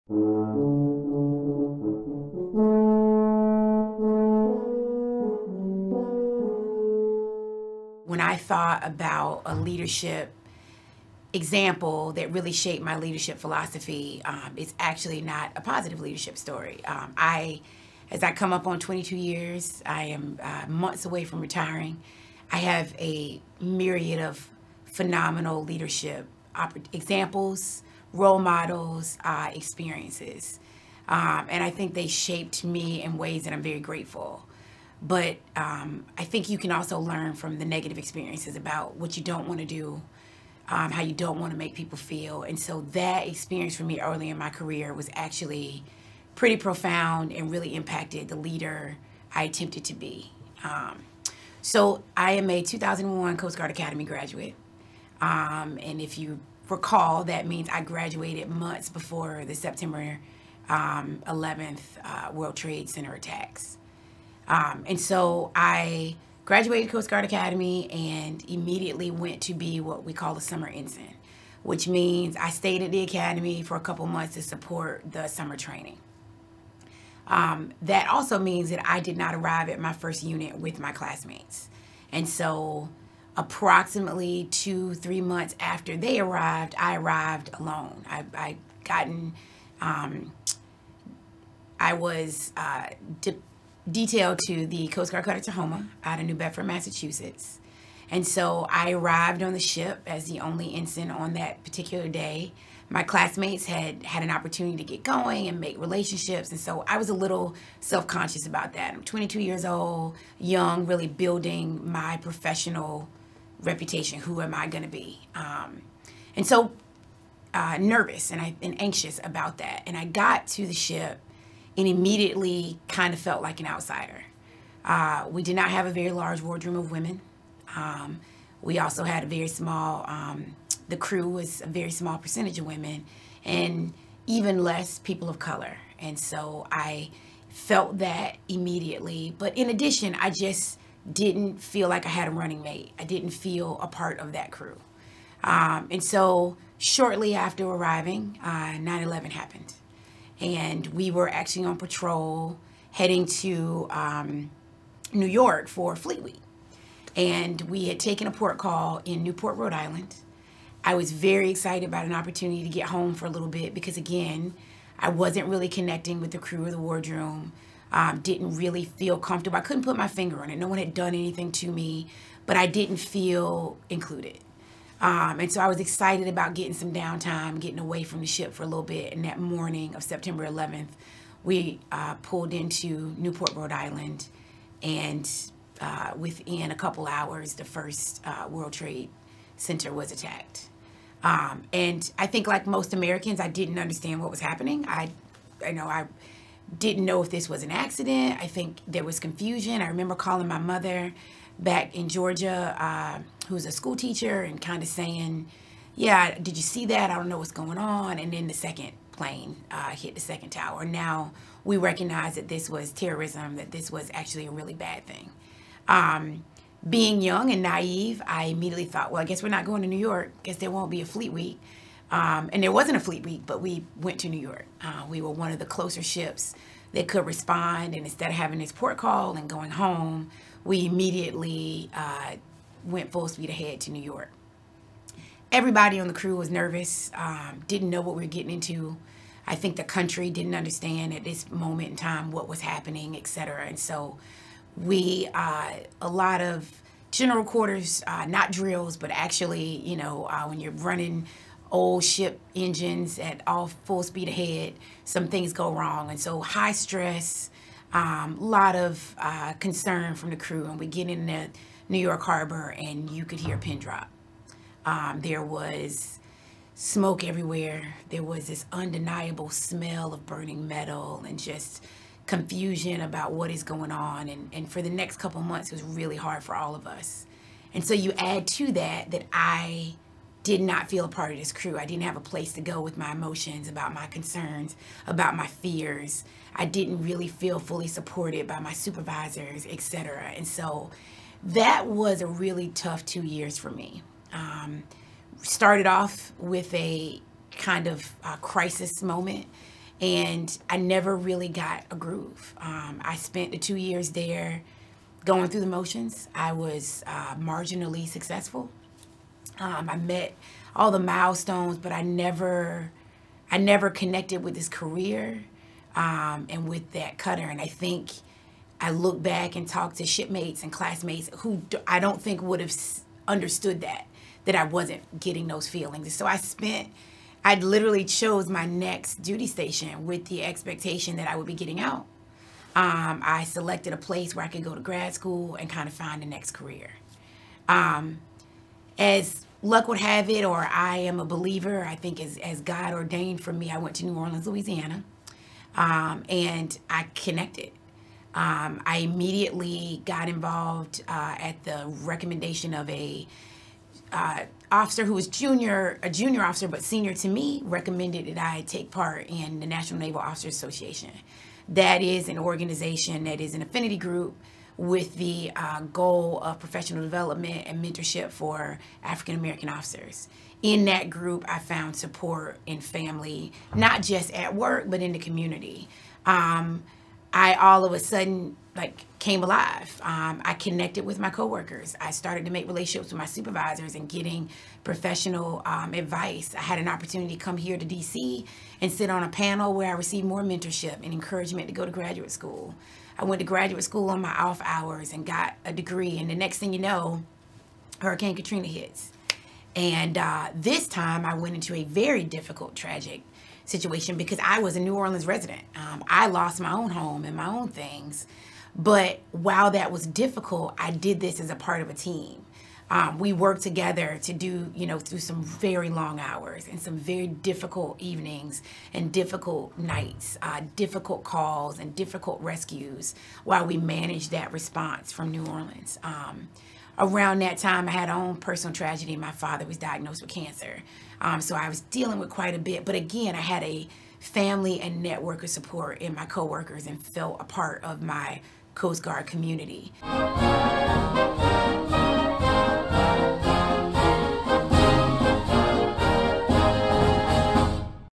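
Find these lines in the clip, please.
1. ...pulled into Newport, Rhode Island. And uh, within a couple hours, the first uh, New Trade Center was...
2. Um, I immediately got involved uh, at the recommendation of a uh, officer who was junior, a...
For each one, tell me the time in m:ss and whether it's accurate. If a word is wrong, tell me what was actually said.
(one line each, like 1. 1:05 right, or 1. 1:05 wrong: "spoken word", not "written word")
1. 3:02 wrong: "World", not "New"
2. 5:48 right.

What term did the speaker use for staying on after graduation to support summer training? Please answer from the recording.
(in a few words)
summer ensign.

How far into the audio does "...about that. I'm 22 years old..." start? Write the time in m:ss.
1:48.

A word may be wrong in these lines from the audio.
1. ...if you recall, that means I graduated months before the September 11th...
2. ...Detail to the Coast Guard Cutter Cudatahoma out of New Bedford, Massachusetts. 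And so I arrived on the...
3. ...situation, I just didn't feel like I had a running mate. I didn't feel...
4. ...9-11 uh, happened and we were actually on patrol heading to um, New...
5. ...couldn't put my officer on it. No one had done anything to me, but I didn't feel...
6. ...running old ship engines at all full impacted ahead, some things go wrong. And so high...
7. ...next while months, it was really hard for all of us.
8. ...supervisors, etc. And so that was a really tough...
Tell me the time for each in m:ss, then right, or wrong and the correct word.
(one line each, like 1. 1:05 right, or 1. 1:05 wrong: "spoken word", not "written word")
1. 0:55 right
2. 1:33 right
3. 2:19 wrong: "addition", not "situation"
4. 2:28 right
5. 2:49 wrong: "finger", not "officer"
6. 4:10 wrong: "speed", not "impacted"
7. 4:34 wrong: "couple", not "while"
8. 4:48 right.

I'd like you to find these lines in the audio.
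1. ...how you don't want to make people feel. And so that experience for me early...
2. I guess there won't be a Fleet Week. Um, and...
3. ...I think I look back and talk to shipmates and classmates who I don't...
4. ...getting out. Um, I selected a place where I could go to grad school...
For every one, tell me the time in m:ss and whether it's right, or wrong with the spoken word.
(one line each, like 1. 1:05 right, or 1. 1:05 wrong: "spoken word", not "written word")
1. 0:40 right
2. 3:40 right
3. 5:17 right
4. 5:31 right.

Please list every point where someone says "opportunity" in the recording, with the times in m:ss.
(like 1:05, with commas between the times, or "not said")
1:44, 2:42, 6:26.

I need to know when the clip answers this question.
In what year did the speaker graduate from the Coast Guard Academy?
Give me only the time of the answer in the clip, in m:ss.
0:52.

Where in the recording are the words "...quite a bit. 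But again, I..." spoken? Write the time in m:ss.
7:12.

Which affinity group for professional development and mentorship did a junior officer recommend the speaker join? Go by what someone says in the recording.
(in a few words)
National Naval Officers Association.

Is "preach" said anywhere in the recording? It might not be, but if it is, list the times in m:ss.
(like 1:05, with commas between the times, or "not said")
not said.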